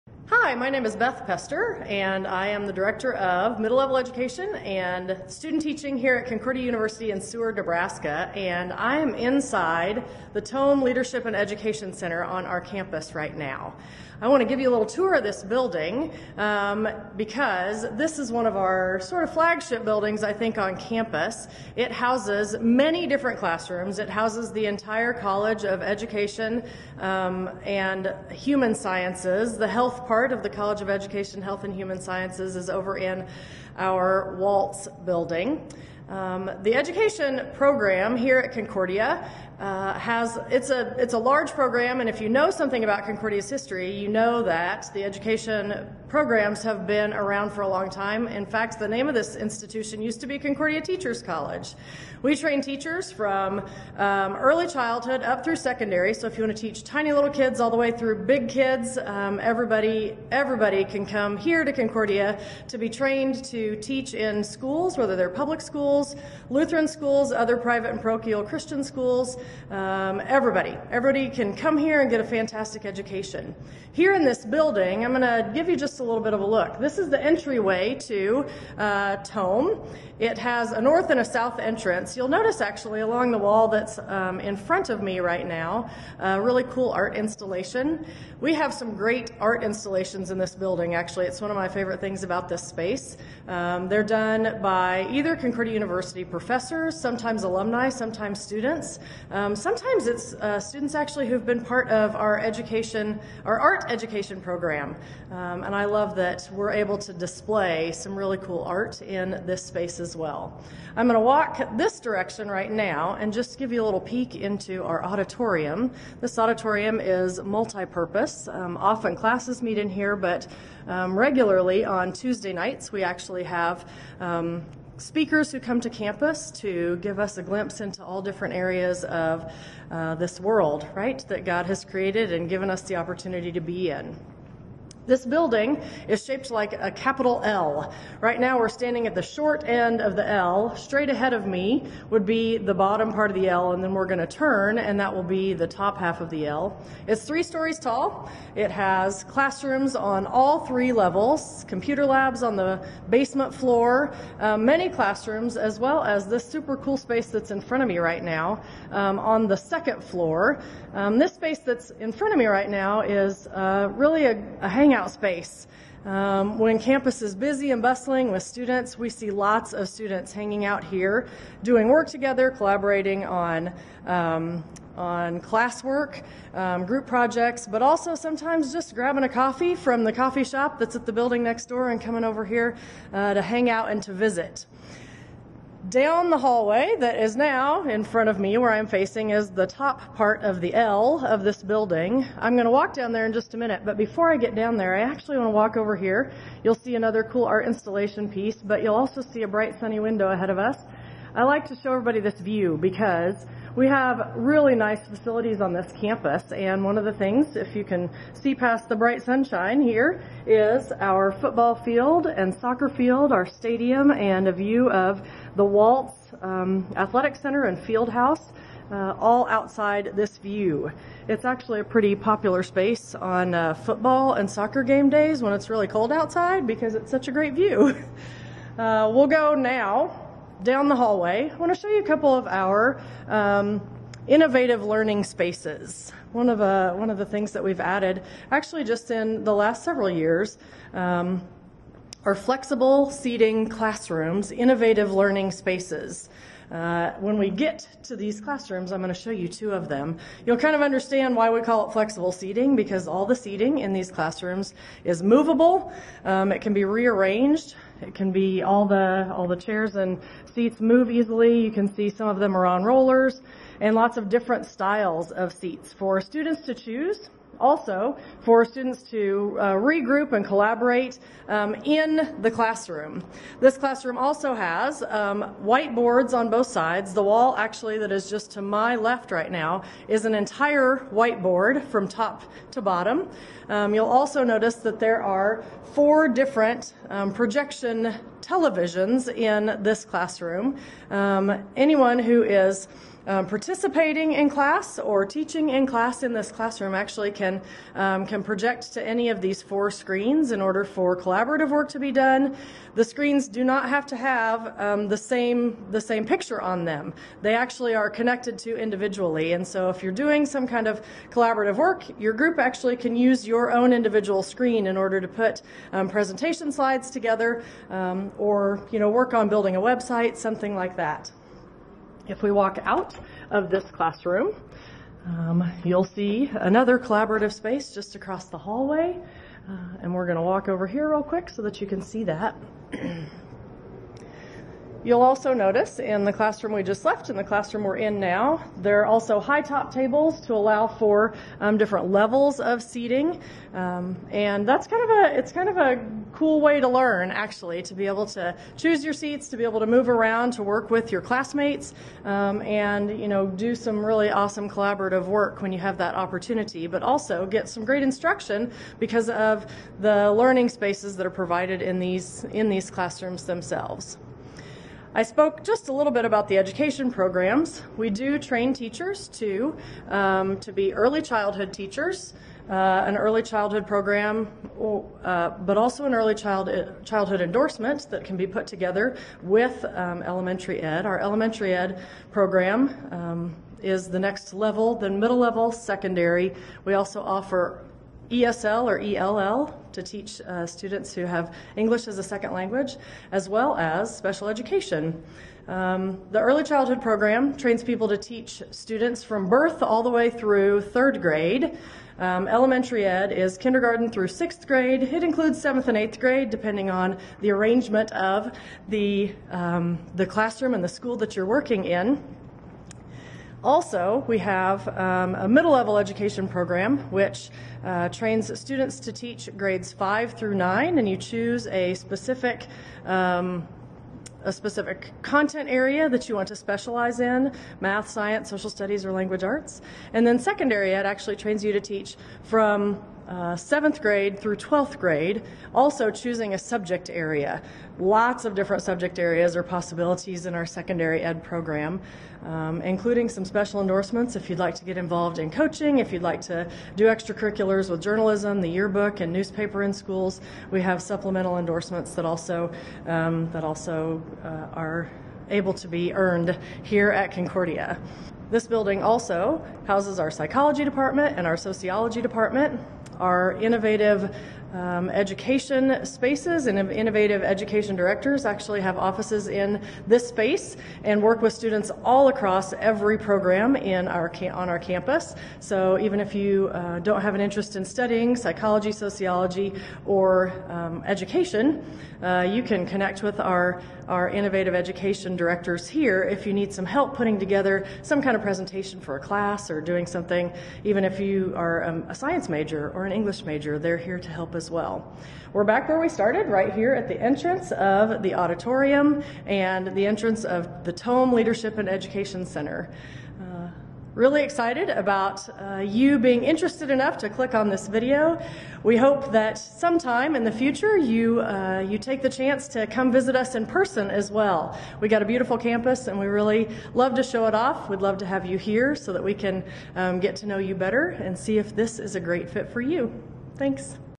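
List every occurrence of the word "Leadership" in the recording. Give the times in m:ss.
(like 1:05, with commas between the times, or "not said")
0:10, 8:21.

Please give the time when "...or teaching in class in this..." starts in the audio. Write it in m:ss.
4:54.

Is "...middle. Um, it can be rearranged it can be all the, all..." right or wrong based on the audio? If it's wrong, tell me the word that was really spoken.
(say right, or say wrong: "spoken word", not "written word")
wrong: "movable", not "middle".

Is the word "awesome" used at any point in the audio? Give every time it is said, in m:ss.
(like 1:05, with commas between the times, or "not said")
5:54.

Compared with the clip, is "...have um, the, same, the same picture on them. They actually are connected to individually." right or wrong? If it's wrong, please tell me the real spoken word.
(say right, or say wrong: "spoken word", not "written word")
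right.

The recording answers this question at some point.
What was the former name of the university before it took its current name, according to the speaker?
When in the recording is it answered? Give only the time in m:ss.
0:50.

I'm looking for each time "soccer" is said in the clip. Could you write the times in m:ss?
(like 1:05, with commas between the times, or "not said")
3:32, 3:44.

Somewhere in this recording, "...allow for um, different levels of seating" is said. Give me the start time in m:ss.
5:40.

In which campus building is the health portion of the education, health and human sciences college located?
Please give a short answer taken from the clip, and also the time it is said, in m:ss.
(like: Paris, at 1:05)
Walz building, at 0:34.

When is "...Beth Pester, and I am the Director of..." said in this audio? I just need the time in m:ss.
0:00.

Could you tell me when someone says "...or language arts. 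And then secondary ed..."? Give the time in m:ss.
7:09.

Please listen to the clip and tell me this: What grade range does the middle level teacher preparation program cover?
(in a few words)
5 through 9.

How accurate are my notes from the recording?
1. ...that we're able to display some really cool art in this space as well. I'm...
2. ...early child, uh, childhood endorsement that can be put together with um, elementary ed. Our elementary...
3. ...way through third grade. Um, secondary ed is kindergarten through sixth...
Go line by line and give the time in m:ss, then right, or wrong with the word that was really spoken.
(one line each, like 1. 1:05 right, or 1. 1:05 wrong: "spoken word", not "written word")
1. 1:46 right
2. 6:16 right
3. 6:40 wrong: "elementary", not "secondary".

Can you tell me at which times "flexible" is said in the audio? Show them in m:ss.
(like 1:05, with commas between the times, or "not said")
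4:02, 4:11.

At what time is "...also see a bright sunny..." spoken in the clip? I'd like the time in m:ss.
3:18.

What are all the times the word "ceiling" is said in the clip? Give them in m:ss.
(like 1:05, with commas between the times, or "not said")
not said.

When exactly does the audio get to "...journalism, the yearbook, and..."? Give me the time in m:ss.
7:28.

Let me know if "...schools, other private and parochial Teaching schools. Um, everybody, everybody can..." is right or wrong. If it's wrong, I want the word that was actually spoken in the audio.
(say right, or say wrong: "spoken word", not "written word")
wrong: "Christian", not "Teaching".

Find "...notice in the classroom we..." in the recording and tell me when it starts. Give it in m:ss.
5:35.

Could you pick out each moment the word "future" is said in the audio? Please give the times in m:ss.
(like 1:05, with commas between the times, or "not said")
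8:30.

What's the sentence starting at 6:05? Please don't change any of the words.
I spoke just a little bit about the education programs.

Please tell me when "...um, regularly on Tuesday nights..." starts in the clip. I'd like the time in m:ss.
2:00.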